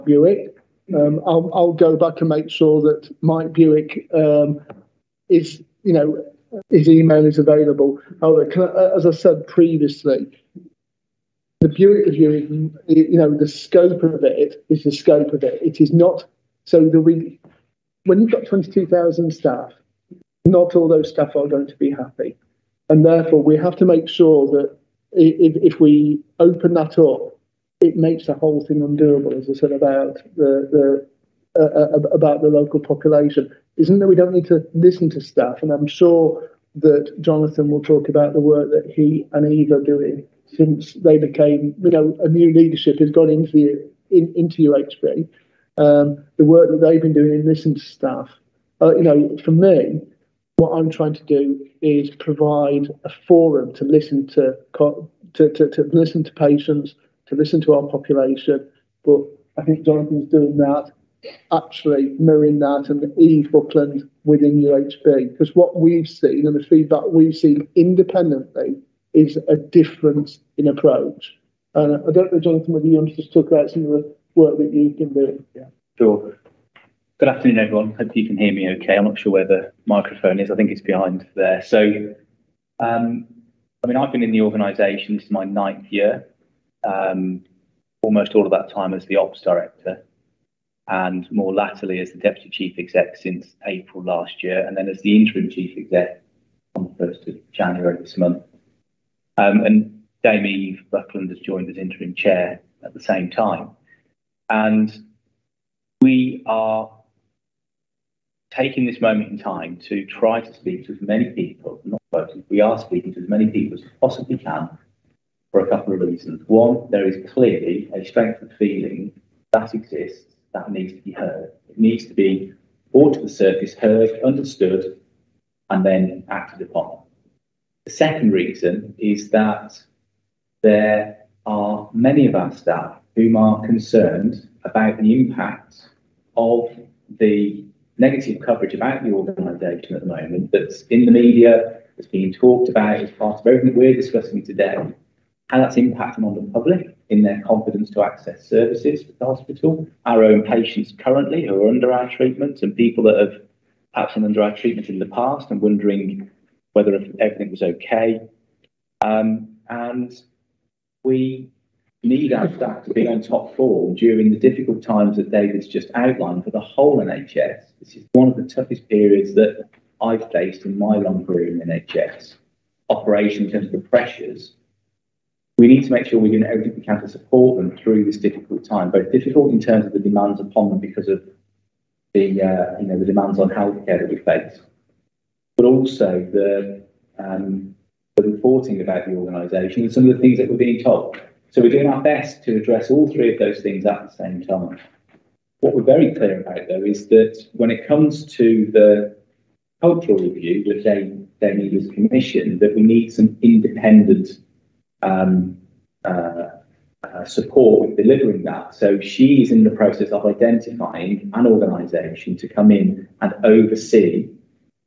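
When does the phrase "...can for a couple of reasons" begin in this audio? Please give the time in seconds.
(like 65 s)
114 s.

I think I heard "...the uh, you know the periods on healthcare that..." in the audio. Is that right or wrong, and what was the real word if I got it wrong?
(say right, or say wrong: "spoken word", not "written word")
wrong: "demands", not "periods".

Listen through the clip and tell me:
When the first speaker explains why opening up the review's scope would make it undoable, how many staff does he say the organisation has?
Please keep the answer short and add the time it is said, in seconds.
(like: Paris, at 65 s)
22,000, at 18 s.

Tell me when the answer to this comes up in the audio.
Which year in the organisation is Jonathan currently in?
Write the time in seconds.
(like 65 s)
85 s.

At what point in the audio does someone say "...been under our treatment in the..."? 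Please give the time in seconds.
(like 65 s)
154 s.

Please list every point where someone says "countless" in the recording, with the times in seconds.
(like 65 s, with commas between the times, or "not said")
not said.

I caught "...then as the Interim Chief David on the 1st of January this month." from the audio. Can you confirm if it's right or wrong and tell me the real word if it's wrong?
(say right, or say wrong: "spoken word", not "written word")
wrong: "Exec", not "David".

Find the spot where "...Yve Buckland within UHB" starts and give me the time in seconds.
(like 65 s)
63 s.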